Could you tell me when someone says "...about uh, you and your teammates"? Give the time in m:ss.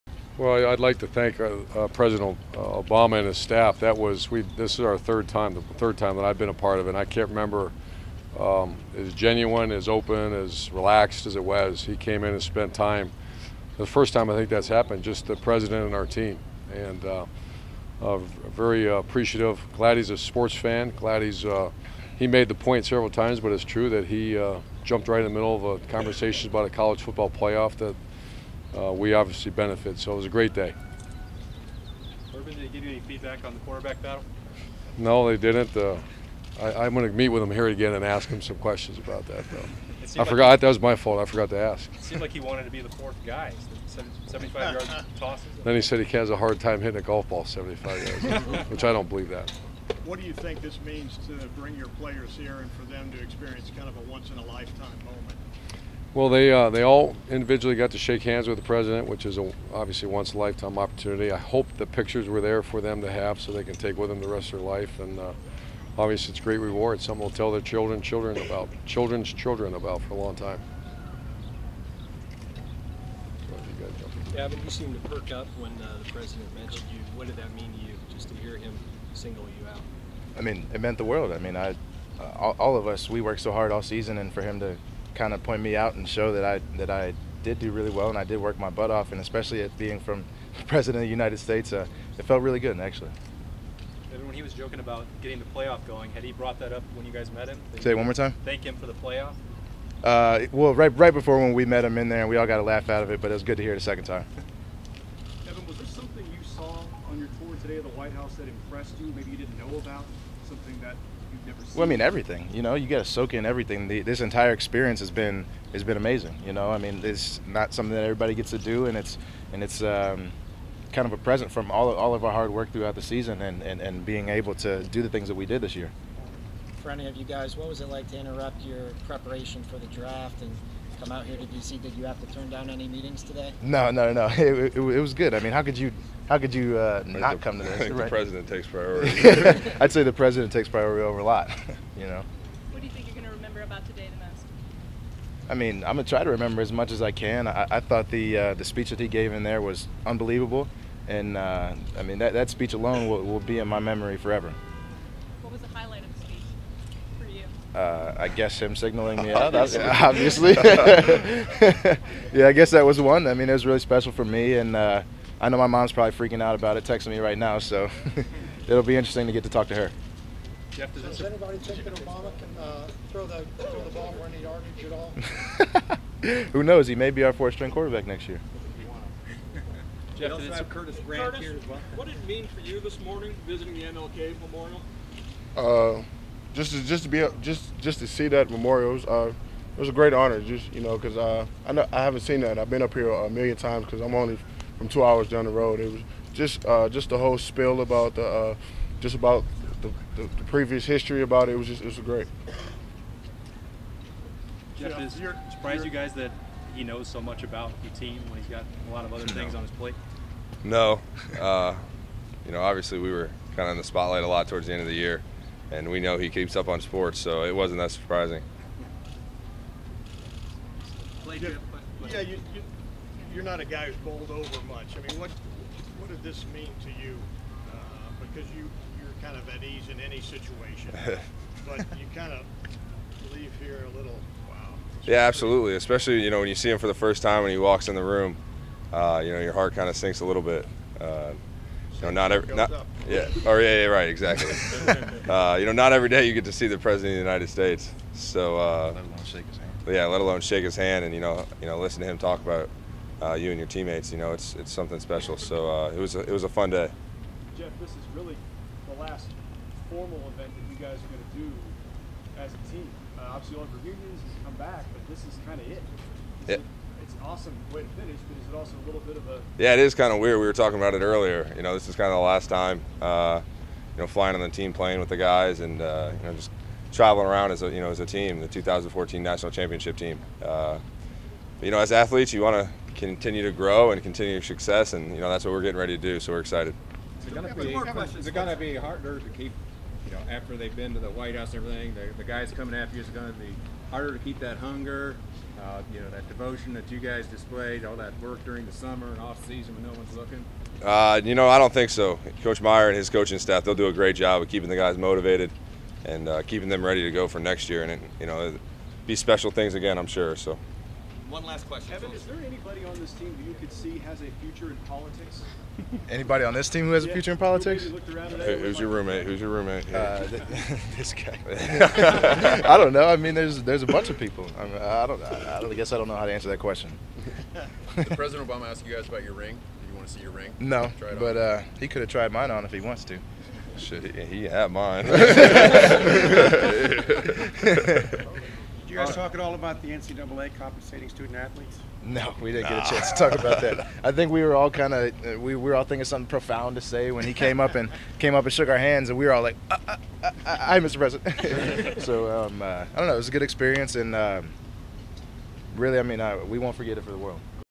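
4:12.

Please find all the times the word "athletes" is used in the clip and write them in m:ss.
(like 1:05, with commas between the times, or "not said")
4:41, 5:41.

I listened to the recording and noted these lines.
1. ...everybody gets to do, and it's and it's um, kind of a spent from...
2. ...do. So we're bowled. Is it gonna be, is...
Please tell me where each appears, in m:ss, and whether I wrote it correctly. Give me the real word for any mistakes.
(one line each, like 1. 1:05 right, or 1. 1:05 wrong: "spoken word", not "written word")
1. 1:58 wrong: "present", not "spent"
2. 4:46 wrong: "excited", not "bowled".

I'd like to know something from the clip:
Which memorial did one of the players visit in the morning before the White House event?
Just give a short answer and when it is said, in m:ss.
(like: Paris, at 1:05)
MLK Memorial, at 3:03.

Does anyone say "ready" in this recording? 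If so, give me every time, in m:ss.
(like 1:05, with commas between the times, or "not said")
4:45, 5:06.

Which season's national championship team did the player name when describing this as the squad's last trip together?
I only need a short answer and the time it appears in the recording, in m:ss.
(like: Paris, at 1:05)
2014, at 4:38.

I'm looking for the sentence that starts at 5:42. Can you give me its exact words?
No, we didn't get a chance to talk about that.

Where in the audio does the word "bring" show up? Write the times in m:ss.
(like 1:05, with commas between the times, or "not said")
0:51.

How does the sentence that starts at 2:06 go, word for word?
For any of you guys, what was it like to interrupt your preparation for the draft and?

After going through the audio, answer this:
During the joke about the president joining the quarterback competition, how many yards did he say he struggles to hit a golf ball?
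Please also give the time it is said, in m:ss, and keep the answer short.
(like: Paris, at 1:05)
75, at 0:47.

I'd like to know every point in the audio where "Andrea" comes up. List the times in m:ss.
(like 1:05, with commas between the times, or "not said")
not said.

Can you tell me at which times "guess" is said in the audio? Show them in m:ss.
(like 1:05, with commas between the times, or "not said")
2:38, 2:42, 5:25.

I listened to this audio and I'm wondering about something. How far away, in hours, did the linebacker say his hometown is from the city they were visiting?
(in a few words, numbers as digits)
2 hours.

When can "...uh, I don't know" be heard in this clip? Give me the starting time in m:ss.
5:52.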